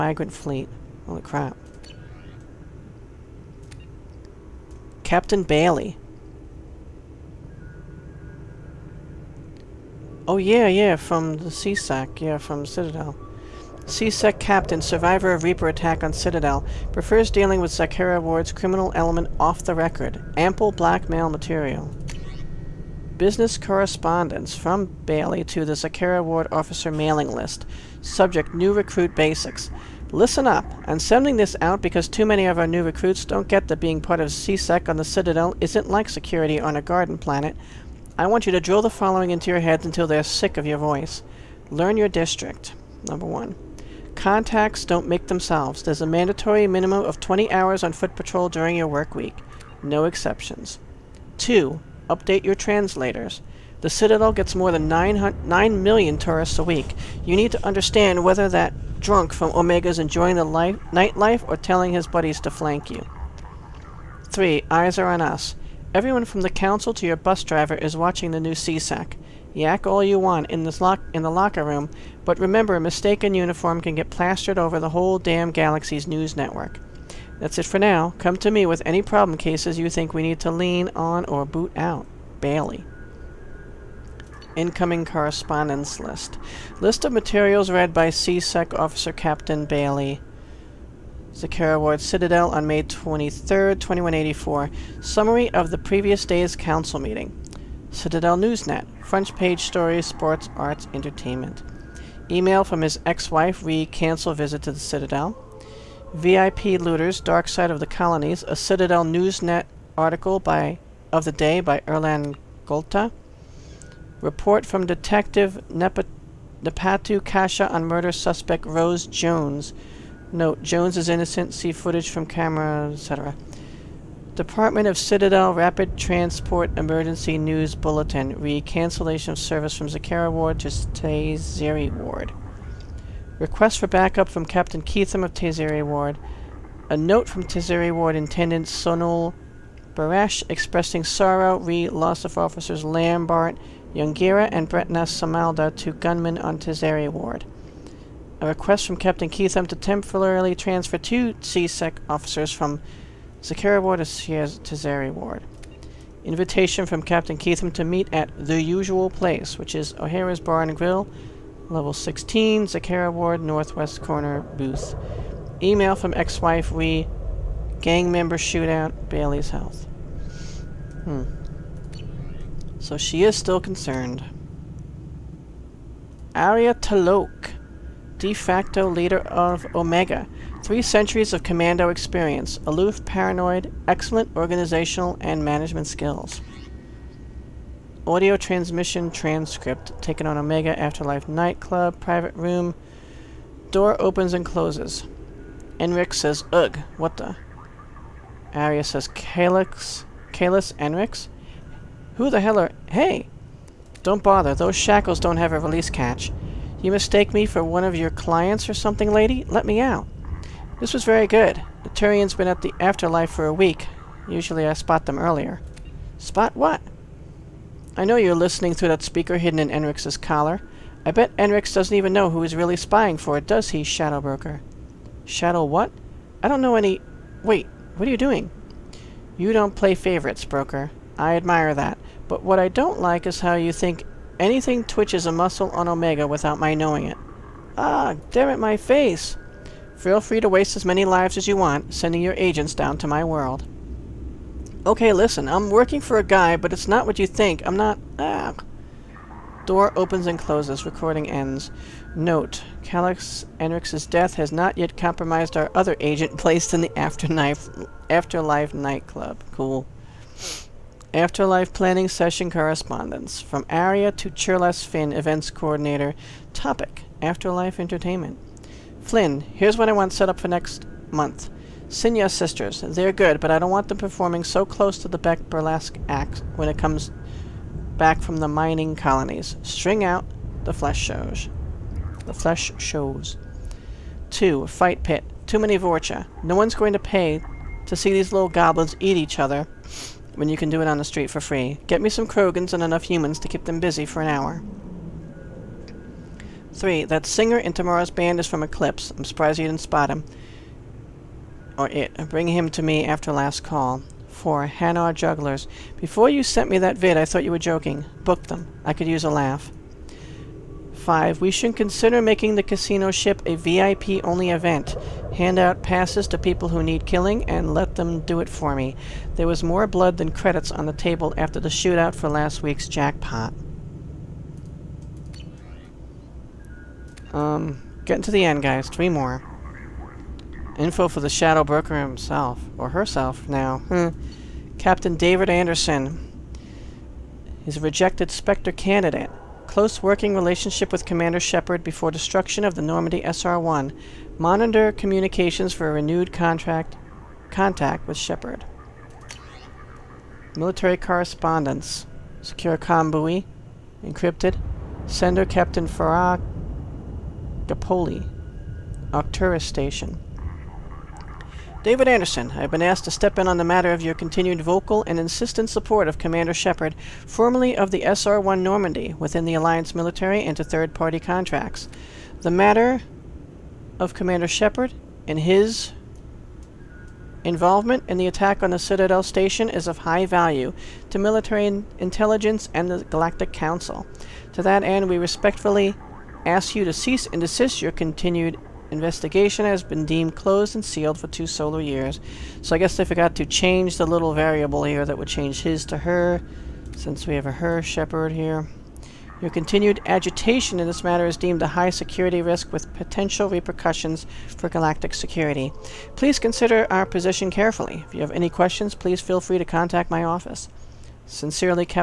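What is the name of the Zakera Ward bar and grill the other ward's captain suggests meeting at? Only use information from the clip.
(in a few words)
O'Hara's Bar and Grill.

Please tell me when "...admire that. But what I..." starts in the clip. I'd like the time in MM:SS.
03:51.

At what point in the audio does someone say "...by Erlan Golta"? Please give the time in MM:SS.
01:51.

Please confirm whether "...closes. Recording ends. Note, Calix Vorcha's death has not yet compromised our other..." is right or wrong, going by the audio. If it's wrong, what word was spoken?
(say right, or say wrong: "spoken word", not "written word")
wrong: "Enrix", not "Vorcha".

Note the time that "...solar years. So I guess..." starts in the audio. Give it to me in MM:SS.
06:31.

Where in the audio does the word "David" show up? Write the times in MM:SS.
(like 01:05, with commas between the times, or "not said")
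05:35, 06:01.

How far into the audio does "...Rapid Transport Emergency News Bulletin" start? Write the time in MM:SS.
02:05.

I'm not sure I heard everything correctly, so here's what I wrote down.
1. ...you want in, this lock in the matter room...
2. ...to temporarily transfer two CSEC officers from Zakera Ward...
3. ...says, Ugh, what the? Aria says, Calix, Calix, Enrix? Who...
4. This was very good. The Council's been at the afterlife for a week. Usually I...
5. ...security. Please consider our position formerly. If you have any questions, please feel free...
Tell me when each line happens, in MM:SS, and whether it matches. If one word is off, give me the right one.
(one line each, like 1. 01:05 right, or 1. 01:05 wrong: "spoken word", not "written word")
1. 01:10 wrong: "locker", not "matter"
2. 02:29 right
3. 03:16 right
4. 03:30 wrong: "Turian", not "Council"
5. 06:45 wrong: "carefully", not "formerly".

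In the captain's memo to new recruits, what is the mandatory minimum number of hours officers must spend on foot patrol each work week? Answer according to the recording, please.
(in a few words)
20.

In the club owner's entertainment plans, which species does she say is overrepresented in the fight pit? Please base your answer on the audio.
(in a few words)
Vorcha.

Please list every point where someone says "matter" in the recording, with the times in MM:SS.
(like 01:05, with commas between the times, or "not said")
06:03, 06:12, 06:41.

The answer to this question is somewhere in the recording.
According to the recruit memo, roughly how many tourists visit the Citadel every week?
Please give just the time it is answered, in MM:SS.
00:54.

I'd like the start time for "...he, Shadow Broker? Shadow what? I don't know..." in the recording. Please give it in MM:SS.
03:43.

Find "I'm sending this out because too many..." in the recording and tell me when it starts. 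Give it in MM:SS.
00:30.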